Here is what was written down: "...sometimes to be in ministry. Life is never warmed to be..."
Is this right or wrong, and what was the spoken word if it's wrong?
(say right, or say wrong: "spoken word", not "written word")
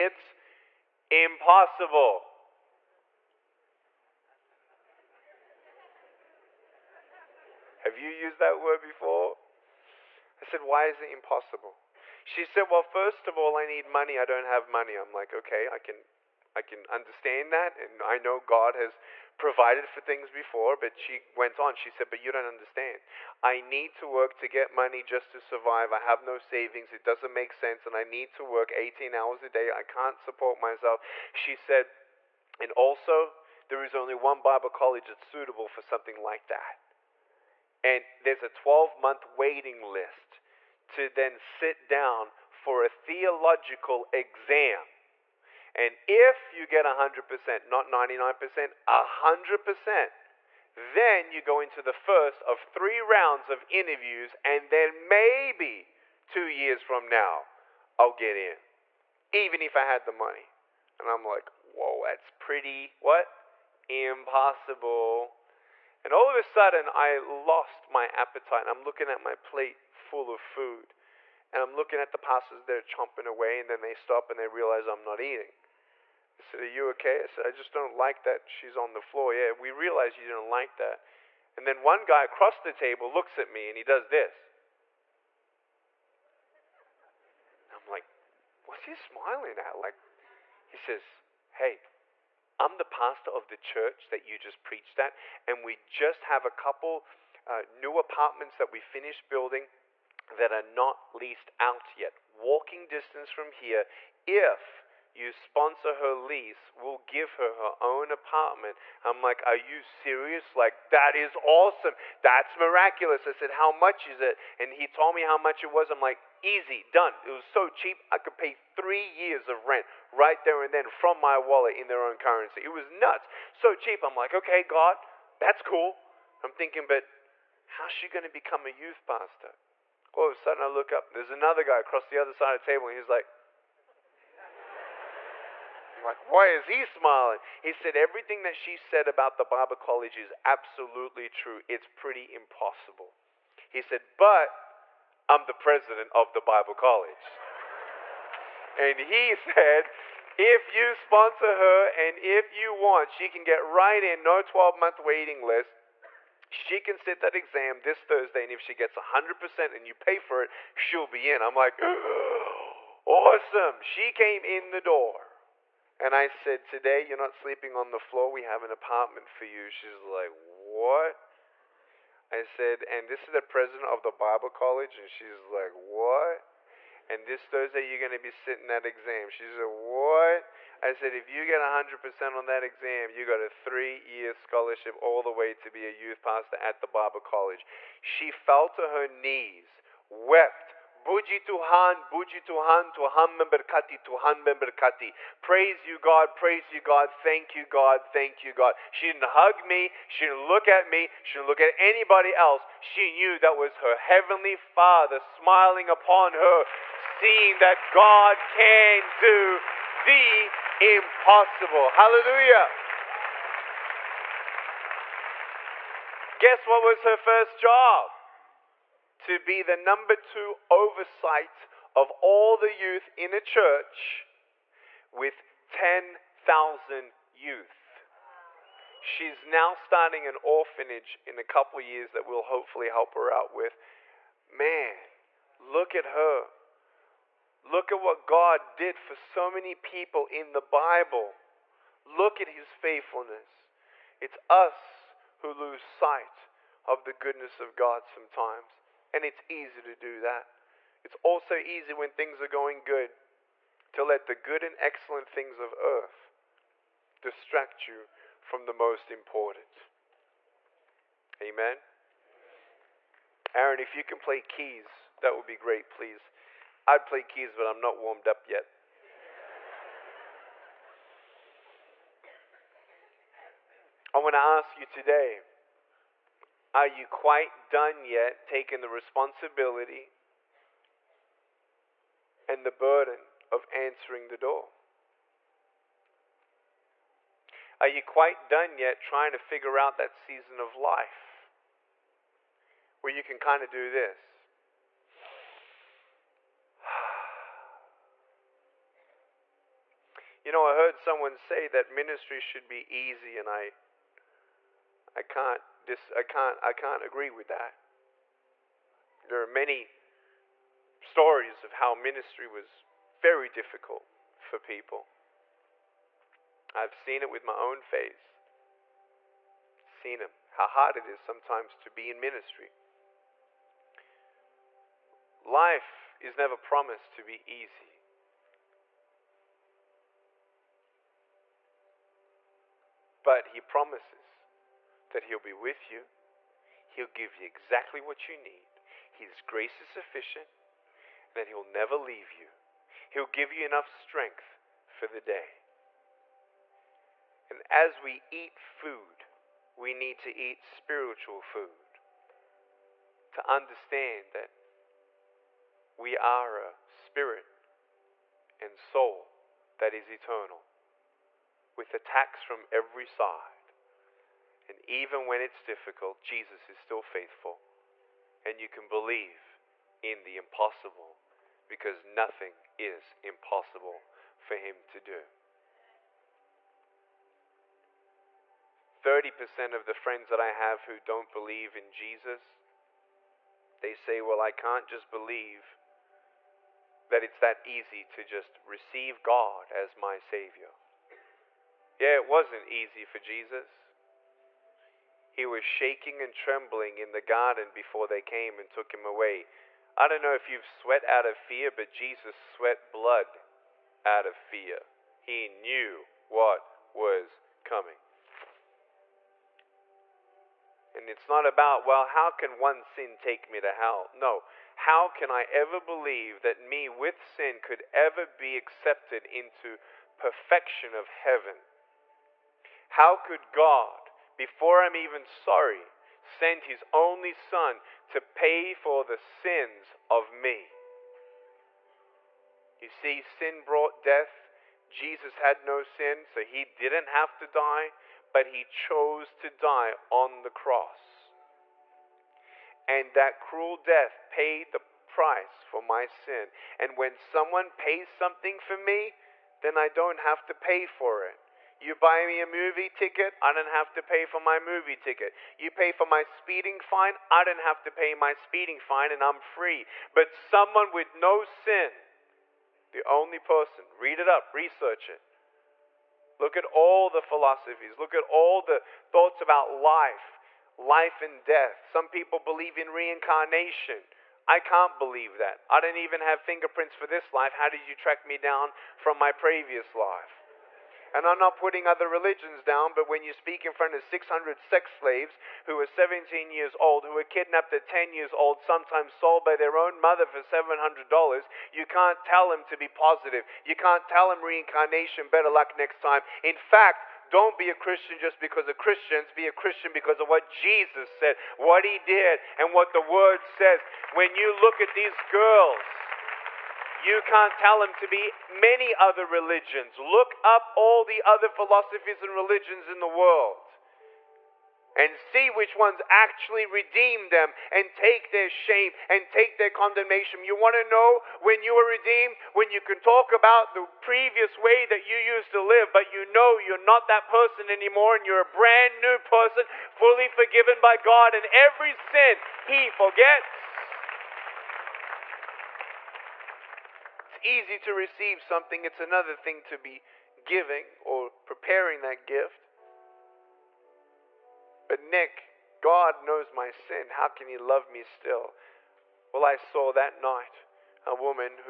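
wrong: "promised", not "warmed".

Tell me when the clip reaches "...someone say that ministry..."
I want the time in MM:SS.
05:00.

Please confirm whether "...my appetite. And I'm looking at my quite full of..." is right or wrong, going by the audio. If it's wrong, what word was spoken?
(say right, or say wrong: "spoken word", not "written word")
wrong: "plate", not "quite".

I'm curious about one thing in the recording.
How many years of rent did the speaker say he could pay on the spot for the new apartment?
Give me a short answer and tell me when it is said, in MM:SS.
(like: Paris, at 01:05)
3, at 01:58.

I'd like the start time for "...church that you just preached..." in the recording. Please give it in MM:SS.
01:33.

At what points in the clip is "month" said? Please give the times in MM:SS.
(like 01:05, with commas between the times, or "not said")
00:38, 02:34.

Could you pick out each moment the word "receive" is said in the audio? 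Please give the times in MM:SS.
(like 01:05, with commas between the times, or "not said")
06:28, 08:57.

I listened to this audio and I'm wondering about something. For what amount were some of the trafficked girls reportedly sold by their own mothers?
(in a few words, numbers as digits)
$700.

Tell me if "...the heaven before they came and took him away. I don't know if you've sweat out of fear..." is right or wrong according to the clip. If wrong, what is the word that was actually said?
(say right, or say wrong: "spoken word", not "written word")
wrong: "garden", not "heaven".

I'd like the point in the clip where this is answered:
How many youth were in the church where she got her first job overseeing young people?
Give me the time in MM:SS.
03:45.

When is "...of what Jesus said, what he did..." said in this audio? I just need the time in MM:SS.
08:20.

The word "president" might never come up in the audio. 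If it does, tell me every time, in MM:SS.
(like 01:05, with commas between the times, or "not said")
02:25, 02:53.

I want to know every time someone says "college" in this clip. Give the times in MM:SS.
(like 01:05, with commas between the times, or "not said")
00:34, 02:19, 02:26, 02:54, 03:07.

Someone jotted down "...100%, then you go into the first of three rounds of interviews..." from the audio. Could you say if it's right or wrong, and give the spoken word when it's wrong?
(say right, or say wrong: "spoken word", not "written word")
right.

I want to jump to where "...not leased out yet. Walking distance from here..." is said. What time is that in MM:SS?
01:40.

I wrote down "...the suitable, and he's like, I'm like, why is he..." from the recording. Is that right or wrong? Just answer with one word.
wrong.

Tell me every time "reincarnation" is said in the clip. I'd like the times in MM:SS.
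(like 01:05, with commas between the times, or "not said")
07:52, 08:14.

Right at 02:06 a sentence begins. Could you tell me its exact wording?
I'm thinking, but how's she going to become a youth pastor?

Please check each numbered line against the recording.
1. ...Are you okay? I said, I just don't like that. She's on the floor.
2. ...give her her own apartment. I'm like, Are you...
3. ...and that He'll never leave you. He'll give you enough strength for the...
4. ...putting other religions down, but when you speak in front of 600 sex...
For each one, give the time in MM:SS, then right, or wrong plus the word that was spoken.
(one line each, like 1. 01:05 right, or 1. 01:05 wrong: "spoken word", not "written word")
1. 01:16 right
2. 01:46 right
3. 05:40 right
4. 08:01 right.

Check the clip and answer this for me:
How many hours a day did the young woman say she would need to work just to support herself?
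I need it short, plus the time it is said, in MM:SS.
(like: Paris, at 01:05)
18, at 00:28.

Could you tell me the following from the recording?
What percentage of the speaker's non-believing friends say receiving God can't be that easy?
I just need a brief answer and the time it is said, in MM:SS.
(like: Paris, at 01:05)
30%, at 06:19.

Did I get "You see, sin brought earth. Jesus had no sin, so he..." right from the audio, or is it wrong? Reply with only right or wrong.
wrong.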